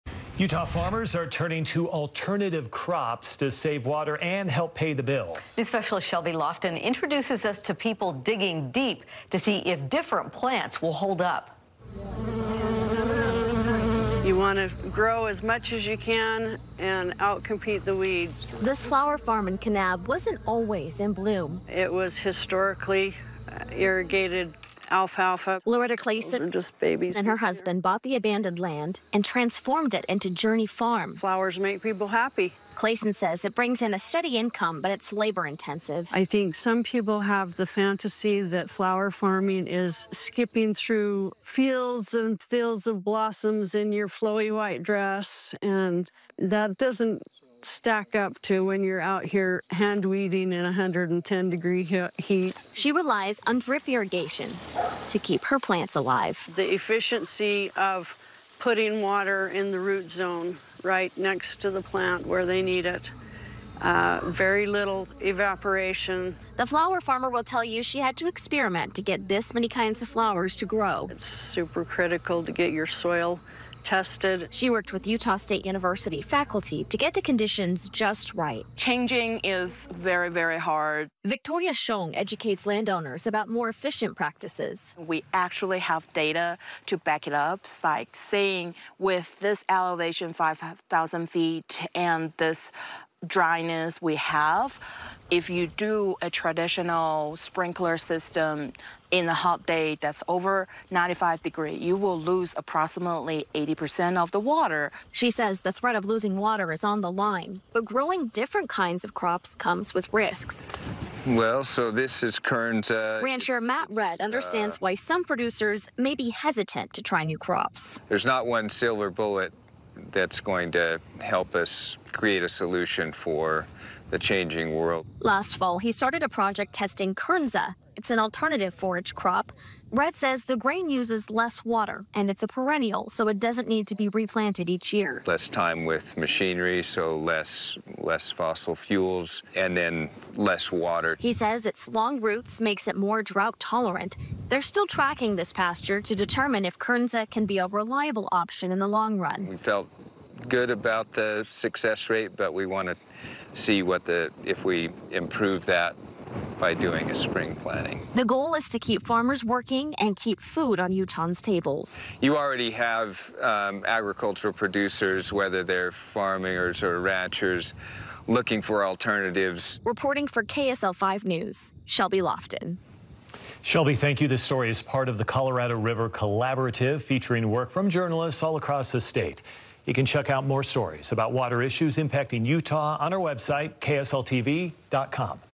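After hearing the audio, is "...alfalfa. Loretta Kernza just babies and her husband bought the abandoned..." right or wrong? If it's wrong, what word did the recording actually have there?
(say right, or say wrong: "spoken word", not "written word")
wrong: "Clayson", not "Kernza".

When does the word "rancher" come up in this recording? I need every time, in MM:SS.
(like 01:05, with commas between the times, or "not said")
01:53, 02:47.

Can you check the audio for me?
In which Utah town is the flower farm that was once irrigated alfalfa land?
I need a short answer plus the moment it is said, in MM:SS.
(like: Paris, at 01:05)
Kanab, at 00:19.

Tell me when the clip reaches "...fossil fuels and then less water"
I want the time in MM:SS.
02:18.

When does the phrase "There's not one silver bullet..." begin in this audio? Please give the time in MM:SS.
01:58.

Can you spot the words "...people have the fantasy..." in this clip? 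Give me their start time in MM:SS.
00:36.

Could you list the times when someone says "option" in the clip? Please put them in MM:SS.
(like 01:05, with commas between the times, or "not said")
02:28.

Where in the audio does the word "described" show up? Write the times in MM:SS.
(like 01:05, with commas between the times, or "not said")
not said.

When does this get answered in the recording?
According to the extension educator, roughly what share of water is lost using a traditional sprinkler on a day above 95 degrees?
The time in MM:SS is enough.
01:43.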